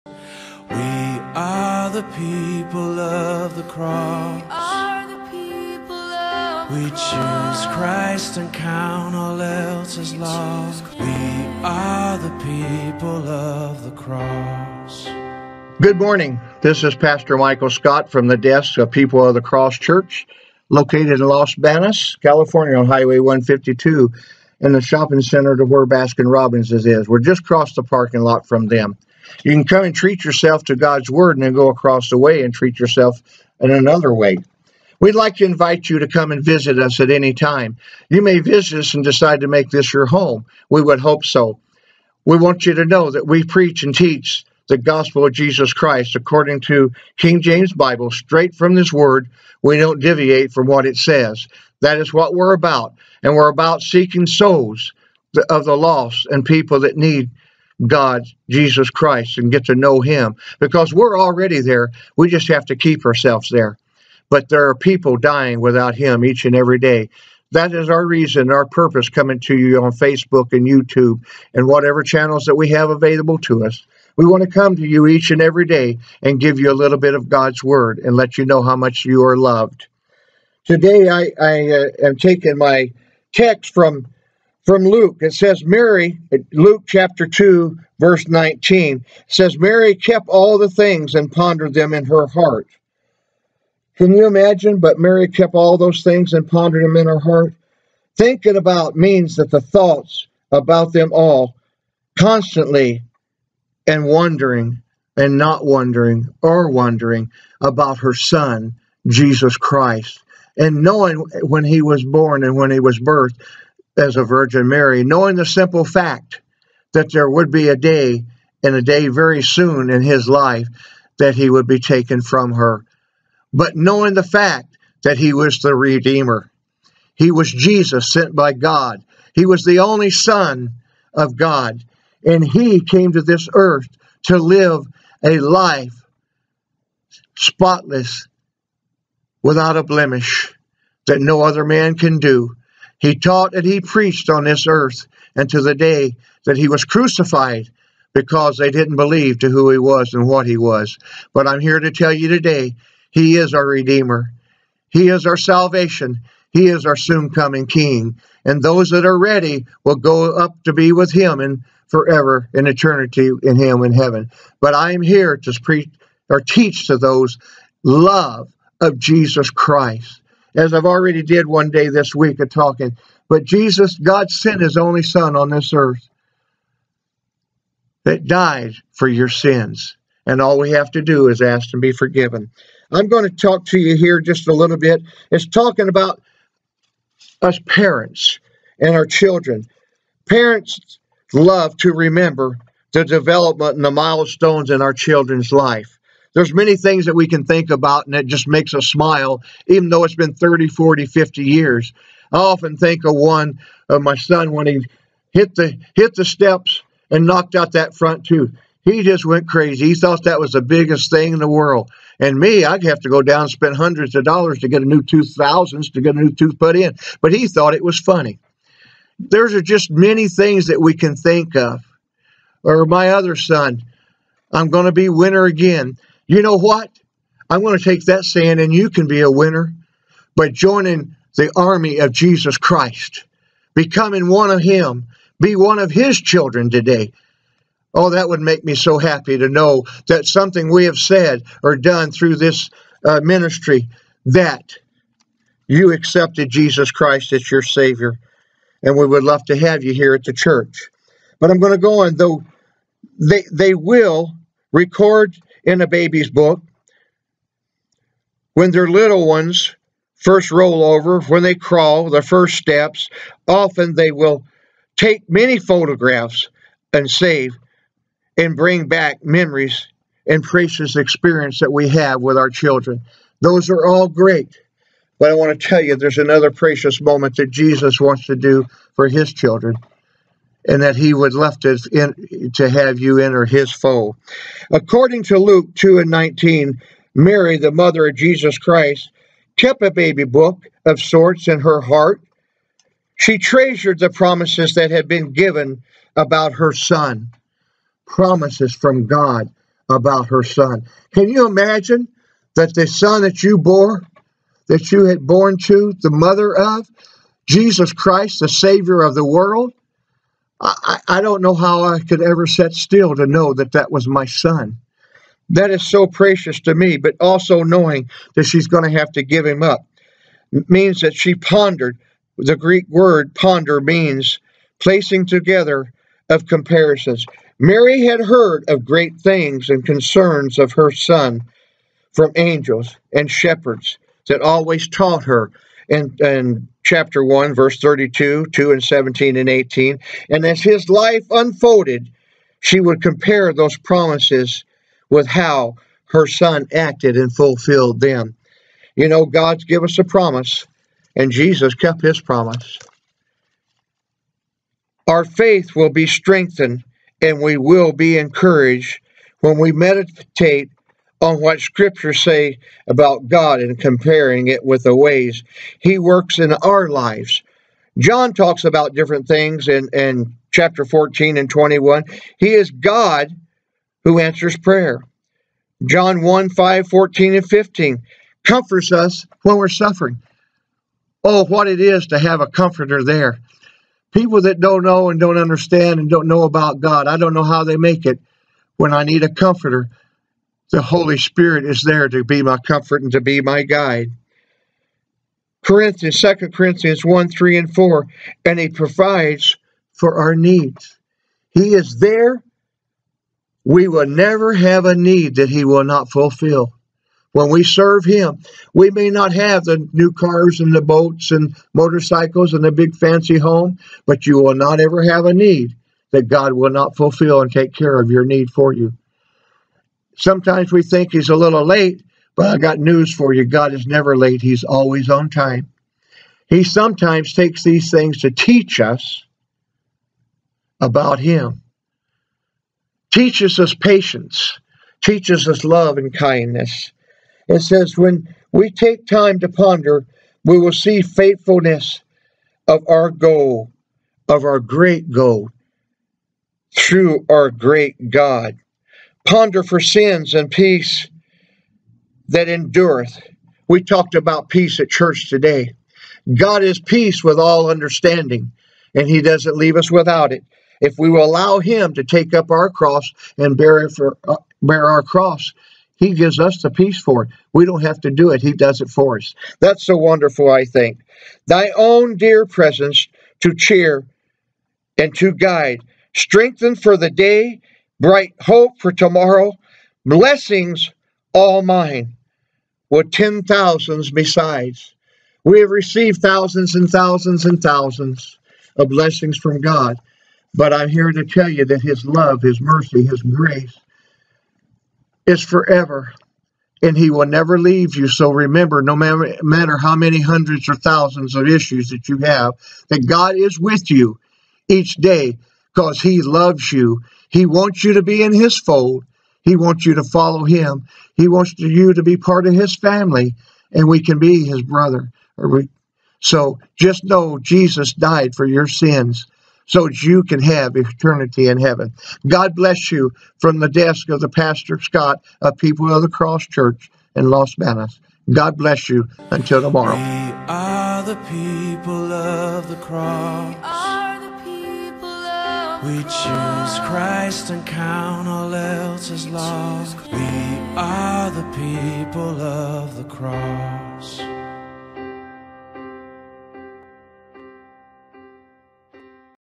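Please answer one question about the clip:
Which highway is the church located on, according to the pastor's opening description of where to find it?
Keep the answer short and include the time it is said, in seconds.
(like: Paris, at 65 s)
Highway 152, at 22 s.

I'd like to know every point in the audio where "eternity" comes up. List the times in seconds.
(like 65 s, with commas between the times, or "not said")
162 s, 520 s.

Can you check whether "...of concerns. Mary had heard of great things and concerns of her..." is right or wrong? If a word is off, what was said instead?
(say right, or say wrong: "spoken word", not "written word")
wrong: "comparisons", not "concerns".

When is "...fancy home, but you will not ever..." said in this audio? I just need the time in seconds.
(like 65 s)
412 s.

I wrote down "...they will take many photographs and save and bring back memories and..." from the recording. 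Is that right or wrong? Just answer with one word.
right.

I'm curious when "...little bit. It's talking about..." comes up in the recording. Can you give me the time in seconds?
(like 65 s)
184 s.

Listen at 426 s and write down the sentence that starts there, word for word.
He sometimes takes these things to teach us about him, teaches us patience, teaches us love and kindness.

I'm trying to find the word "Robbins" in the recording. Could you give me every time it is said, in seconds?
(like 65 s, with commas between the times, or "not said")
26 s.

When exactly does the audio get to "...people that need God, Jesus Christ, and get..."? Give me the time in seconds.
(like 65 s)
56 s.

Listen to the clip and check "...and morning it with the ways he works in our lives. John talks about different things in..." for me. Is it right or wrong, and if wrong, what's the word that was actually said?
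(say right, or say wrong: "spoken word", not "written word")
wrong: "comparing", not "morning".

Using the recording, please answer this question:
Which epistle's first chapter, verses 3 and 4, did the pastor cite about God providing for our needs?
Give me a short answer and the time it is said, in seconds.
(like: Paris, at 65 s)
2 Corinthians, at 396 s.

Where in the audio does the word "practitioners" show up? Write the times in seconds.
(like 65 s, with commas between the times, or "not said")
not said.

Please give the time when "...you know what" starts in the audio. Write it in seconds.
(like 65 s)
226 s.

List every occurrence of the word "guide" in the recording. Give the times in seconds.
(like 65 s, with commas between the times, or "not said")
393 s, 475 s.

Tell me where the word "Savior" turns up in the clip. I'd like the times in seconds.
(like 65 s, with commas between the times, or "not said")
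247 s, 308 s.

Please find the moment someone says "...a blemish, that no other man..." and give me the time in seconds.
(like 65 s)
139 s.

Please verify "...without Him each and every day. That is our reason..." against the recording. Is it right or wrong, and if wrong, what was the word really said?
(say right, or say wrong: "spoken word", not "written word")
right.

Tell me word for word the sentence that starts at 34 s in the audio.
We'd like to invite you to come and visit us at any time.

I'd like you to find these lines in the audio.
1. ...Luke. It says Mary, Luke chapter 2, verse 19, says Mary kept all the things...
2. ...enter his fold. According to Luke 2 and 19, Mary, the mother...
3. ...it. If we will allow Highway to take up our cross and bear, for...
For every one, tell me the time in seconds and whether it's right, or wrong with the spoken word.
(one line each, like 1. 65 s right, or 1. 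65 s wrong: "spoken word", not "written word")
1. 84 s right
2. 283 s right
3. 460 s wrong: "Him", not "Highway".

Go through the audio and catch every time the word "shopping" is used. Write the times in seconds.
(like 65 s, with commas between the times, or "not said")
24 s.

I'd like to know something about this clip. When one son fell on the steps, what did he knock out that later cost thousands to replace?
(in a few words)
front tooth.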